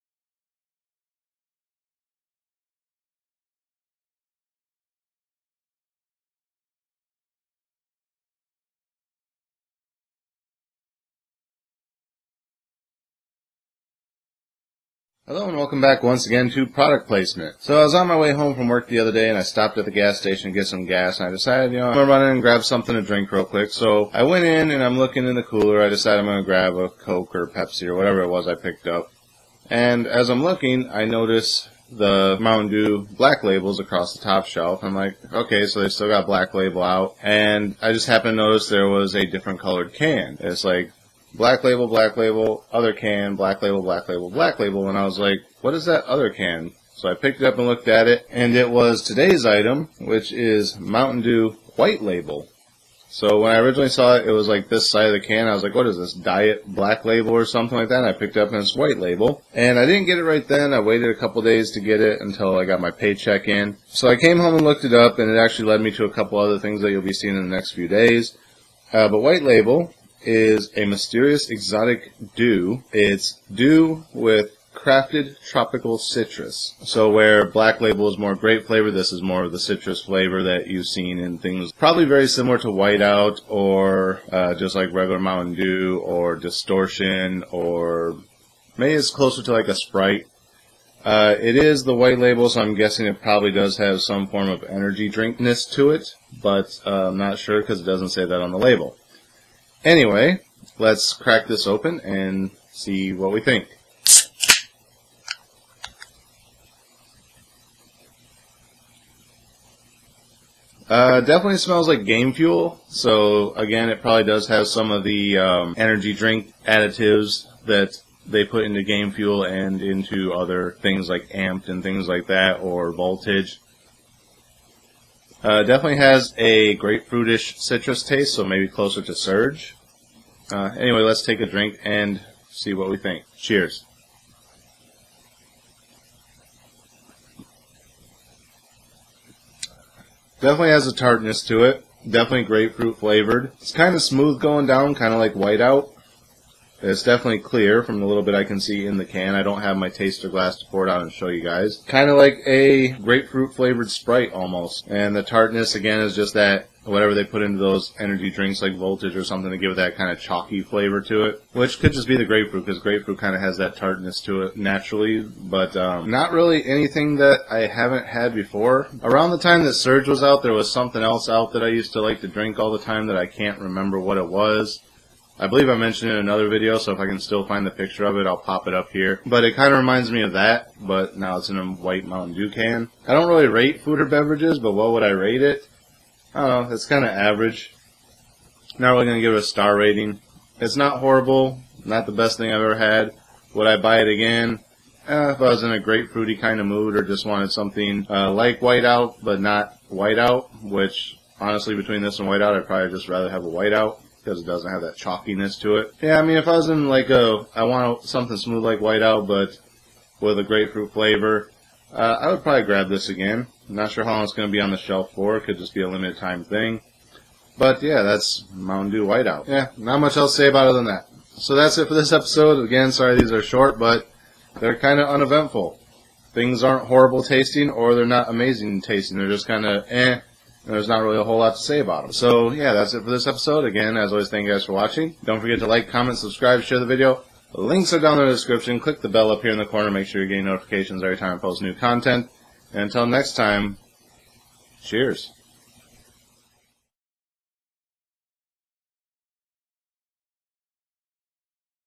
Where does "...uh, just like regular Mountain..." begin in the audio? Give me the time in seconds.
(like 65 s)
84 s.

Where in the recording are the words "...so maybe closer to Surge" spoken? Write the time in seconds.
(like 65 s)
128 s.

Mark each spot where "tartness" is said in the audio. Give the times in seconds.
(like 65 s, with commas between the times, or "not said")
140 s, 155 s, 163 s.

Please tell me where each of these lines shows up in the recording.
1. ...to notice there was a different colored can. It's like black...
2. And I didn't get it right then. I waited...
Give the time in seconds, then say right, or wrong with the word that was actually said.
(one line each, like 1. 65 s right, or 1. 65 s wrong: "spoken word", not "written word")
1. 38 s right
2. 59 s right.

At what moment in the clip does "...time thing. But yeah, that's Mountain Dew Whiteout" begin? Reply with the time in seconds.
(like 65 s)
216 s.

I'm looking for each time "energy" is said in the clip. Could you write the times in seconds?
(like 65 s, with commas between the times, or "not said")
94 s, 115 s, 157 s.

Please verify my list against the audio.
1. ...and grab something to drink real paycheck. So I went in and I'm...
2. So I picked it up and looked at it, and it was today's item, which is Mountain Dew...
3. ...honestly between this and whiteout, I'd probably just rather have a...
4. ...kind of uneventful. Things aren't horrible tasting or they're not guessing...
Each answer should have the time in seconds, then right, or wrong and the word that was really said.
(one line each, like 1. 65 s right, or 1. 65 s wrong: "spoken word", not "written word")
1. 22 s wrong: "quick", not "paycheck"
2. 46 s right
3. 201 s right
4. 224 s wrong: "amazing", not "guessing".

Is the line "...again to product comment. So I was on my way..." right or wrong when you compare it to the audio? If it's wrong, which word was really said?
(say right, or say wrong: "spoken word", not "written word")
wrong: "placement", not "comment".